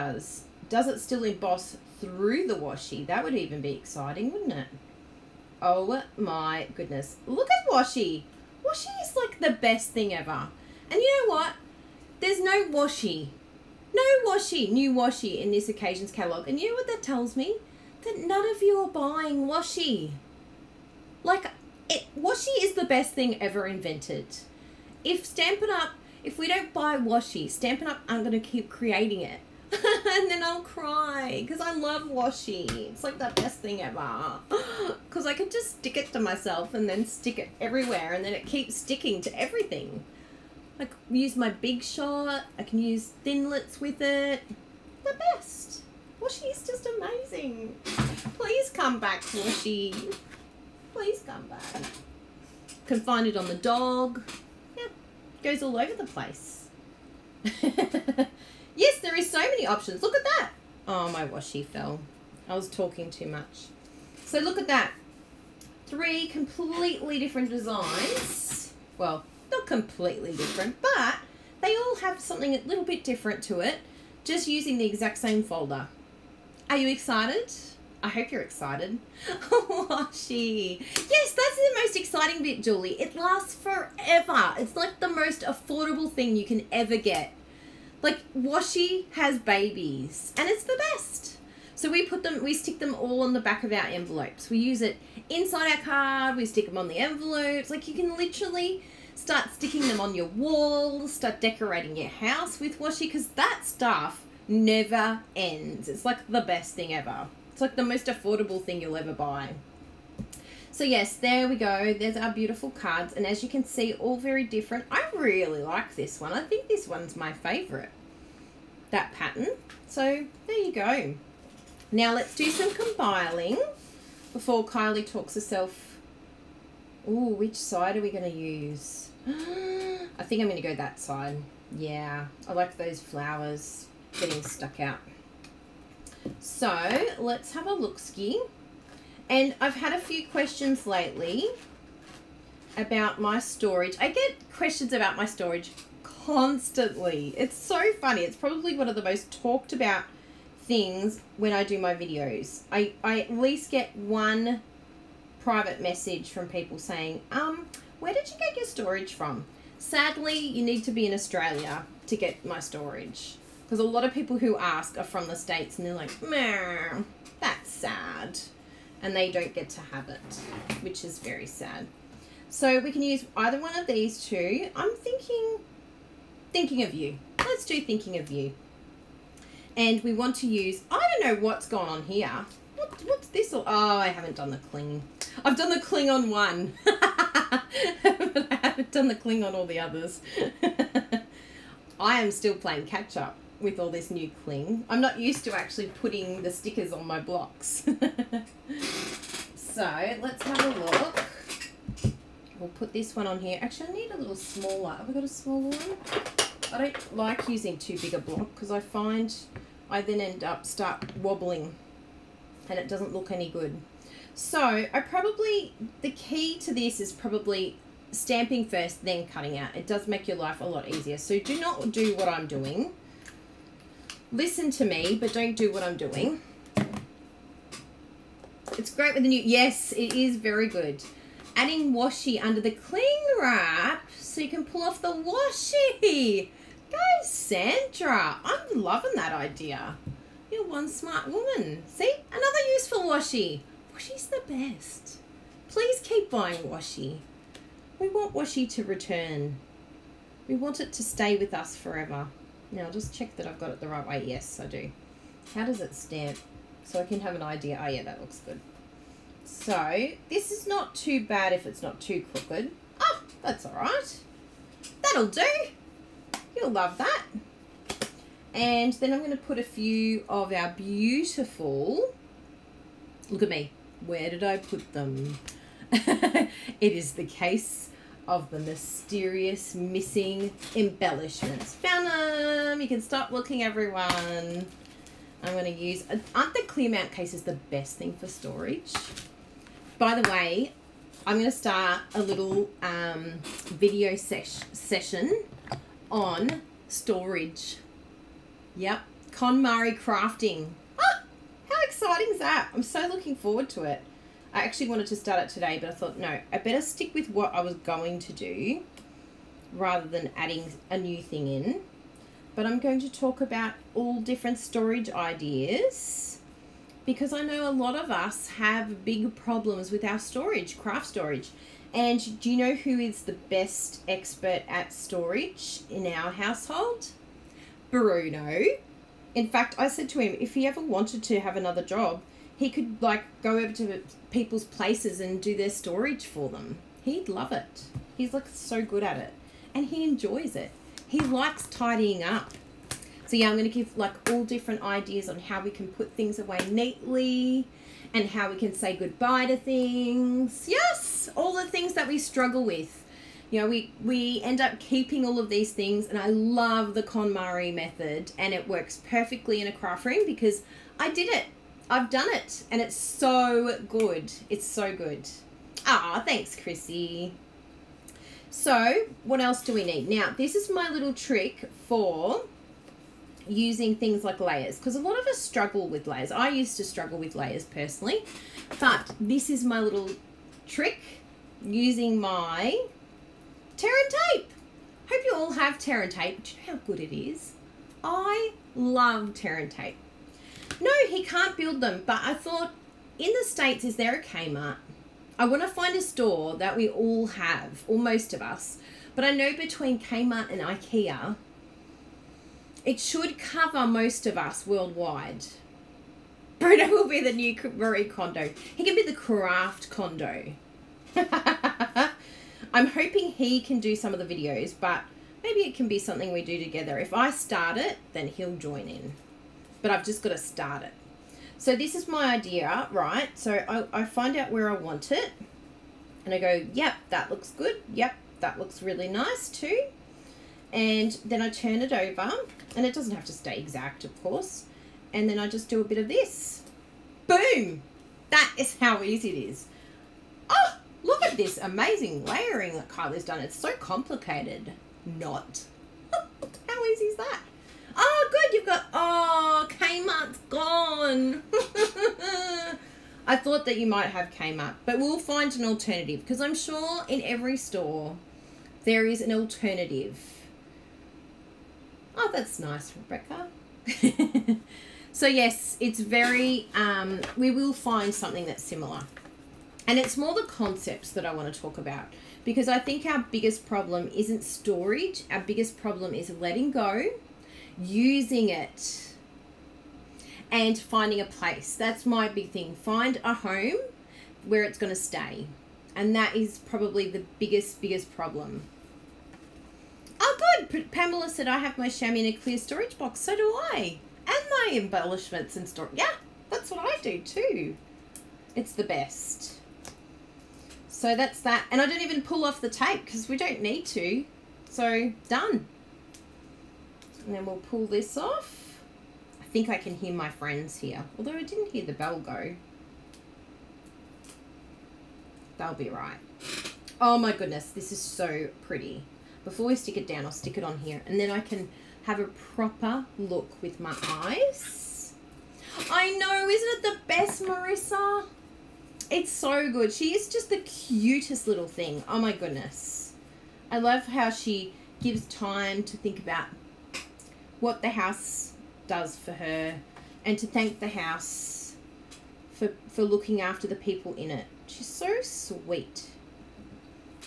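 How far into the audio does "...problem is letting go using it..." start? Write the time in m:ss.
7:55.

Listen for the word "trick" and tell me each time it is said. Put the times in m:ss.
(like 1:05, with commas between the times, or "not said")
6:11, 6:20.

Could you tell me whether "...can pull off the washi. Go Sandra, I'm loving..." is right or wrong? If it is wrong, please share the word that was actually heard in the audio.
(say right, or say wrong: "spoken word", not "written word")
right.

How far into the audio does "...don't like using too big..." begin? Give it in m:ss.
3:26.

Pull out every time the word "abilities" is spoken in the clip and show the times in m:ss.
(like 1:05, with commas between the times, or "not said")
not said.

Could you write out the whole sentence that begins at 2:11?
Yeah, I like those flowers getting stuck out.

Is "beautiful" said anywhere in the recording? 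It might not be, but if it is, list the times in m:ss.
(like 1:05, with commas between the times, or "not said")
1:52, 4:30.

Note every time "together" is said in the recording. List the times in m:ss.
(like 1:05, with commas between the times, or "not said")
6:56.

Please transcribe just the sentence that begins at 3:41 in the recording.
So do not do what I'm doing listen to me, but don't do what I'm doing.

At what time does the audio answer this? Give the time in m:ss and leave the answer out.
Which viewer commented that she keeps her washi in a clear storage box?
8:10.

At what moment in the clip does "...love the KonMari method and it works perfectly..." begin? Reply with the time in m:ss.
5:56.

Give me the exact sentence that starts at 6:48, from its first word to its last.
He can be the craft Kondo.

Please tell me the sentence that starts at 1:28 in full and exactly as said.
Like Washi has babies and it's the best.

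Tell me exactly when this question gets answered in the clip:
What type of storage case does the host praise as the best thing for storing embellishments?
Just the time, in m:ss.
4:46.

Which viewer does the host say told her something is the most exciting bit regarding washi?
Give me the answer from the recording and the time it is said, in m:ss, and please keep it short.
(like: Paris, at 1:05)
Julie, at 1:22.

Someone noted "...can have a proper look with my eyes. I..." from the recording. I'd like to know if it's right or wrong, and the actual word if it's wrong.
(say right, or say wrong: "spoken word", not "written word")
right.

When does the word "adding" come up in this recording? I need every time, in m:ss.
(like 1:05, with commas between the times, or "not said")
3:51, 5:10.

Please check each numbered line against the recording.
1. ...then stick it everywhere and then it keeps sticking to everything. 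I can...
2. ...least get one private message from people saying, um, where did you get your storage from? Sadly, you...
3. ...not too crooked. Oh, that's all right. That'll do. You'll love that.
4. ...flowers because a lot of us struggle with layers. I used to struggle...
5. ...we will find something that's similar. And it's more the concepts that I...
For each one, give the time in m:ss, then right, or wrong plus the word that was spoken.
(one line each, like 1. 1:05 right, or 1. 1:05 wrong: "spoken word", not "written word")
1. 0:36 right
2. 2:33 right
3. 4:21 right
4. 6:14 wrong: "layers", not "flowers"
5. 7:47 right.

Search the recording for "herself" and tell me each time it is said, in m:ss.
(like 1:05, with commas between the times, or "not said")
2:05.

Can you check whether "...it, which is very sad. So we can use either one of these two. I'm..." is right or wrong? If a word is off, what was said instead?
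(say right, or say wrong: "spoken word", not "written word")
right.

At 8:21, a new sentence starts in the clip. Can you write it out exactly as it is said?
And I don't even pull off the tape because we don't need to.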